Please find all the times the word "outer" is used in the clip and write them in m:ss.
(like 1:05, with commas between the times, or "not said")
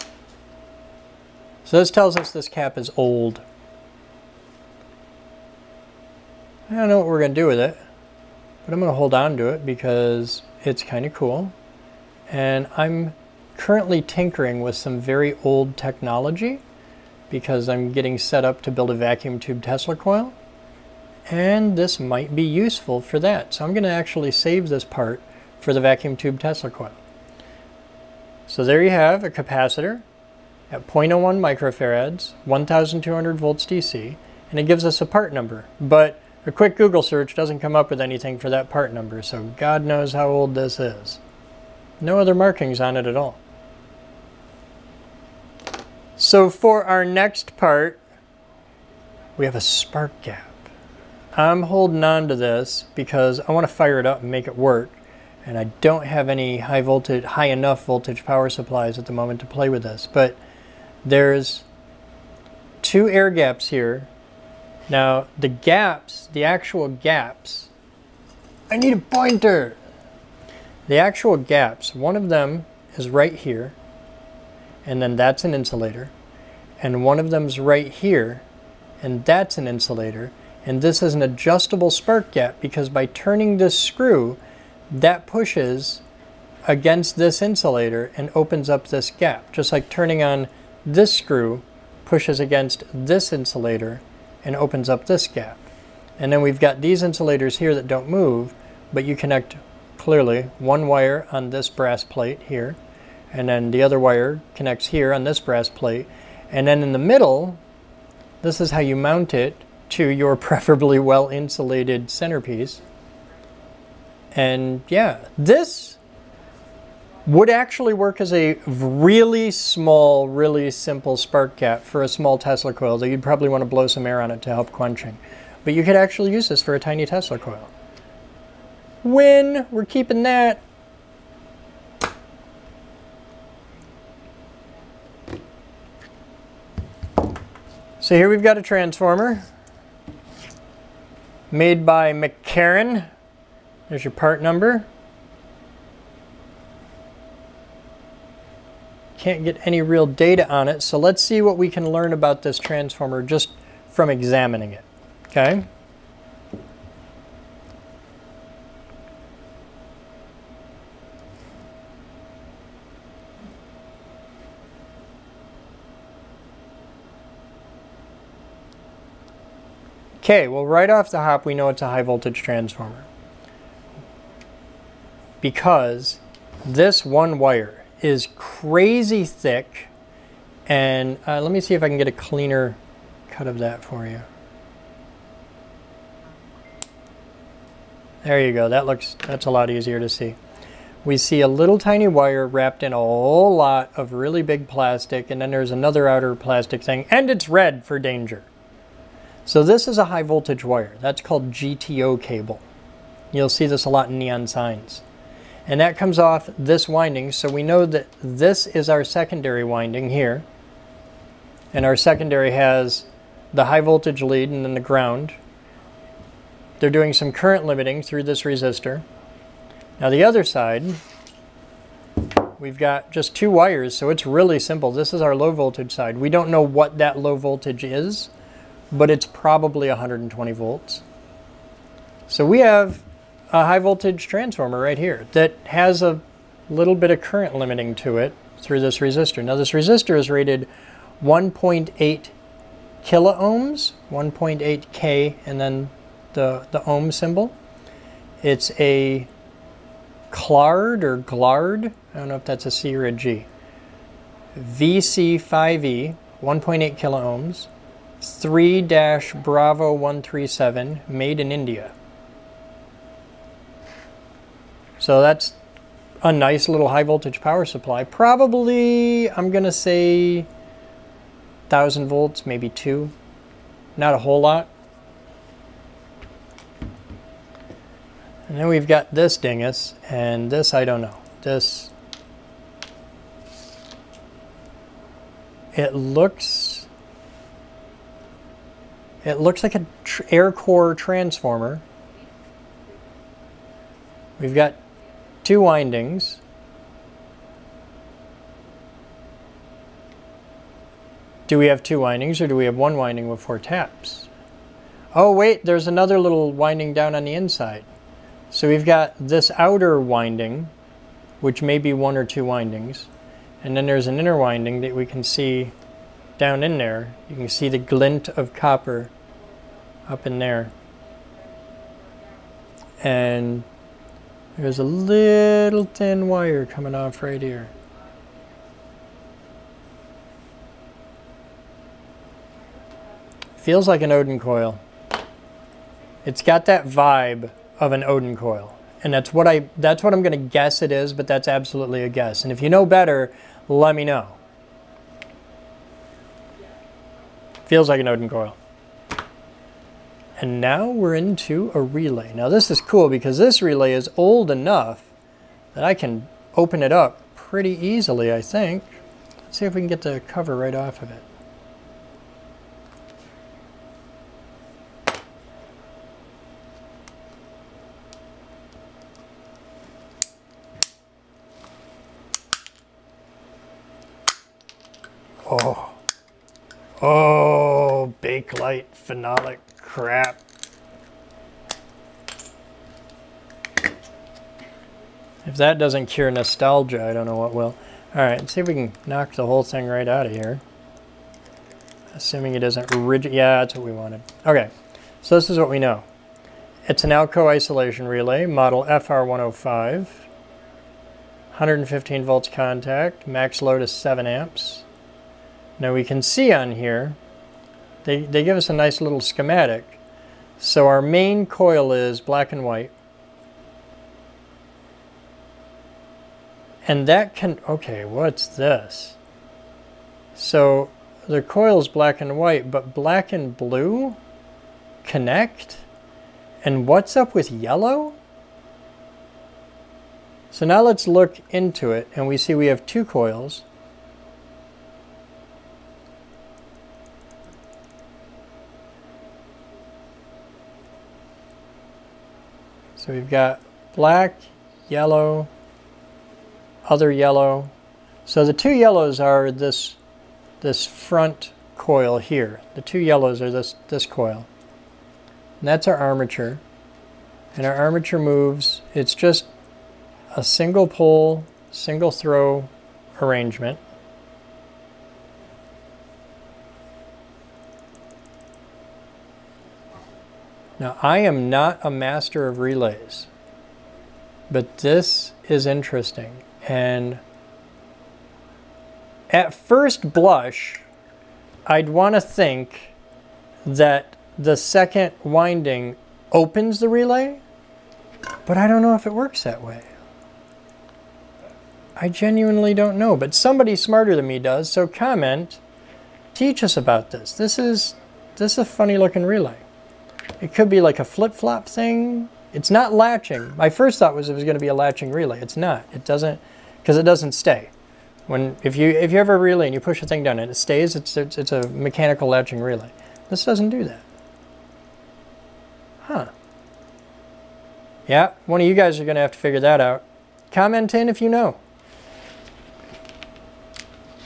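3:16, 5:09.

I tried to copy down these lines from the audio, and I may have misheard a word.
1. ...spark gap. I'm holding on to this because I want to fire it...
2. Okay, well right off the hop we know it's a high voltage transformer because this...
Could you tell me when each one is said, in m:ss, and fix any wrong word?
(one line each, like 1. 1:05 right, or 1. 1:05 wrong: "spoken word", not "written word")
1. 0:49 right
2. 2:50 right.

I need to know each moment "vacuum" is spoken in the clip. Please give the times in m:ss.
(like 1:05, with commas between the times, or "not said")
0:18, 0:25.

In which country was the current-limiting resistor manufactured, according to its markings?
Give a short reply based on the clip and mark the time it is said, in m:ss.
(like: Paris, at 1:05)
India, at 4:21.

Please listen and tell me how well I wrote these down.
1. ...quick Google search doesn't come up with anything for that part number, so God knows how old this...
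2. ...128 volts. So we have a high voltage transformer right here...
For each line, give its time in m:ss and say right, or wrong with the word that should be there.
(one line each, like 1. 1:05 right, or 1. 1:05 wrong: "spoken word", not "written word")
1. 0:36 right
2. 3:49 wrong: "120", not "128".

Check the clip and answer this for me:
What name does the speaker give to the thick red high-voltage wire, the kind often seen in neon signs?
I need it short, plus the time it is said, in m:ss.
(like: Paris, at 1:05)
GTO cable, at 3:21.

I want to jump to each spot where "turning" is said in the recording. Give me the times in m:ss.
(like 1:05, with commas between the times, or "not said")
1:23, 1:29.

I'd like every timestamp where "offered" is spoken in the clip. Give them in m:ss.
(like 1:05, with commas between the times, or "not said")
not said.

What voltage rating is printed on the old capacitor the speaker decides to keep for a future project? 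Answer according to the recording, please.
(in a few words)
1200 volts DC.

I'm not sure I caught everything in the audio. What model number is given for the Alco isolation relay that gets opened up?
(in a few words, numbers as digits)
FR105.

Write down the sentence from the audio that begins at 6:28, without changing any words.
Alright, see if we can knock the whole thing right out of here.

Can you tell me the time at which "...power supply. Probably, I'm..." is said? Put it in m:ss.
4:27.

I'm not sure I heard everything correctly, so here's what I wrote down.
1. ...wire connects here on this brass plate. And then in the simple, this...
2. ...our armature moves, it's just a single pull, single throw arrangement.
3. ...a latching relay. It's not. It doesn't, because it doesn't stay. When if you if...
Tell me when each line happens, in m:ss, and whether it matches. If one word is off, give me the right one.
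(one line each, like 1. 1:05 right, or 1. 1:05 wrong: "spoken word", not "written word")
1. 1:43 wrong: "middle", not "simple"
2. 7:37 right
3. 8:24 right.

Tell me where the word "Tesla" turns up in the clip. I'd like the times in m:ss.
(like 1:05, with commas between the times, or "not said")
0:19, 0:26, 2:02, 2:07.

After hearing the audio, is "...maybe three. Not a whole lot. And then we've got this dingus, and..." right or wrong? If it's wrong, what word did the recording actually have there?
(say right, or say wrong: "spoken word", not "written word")
wrong: "two", not "three".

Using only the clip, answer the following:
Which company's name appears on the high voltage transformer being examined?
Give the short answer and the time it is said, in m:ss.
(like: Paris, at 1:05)
McCarran, at 2:22.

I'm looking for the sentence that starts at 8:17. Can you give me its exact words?
This is, this is a funny looking relay.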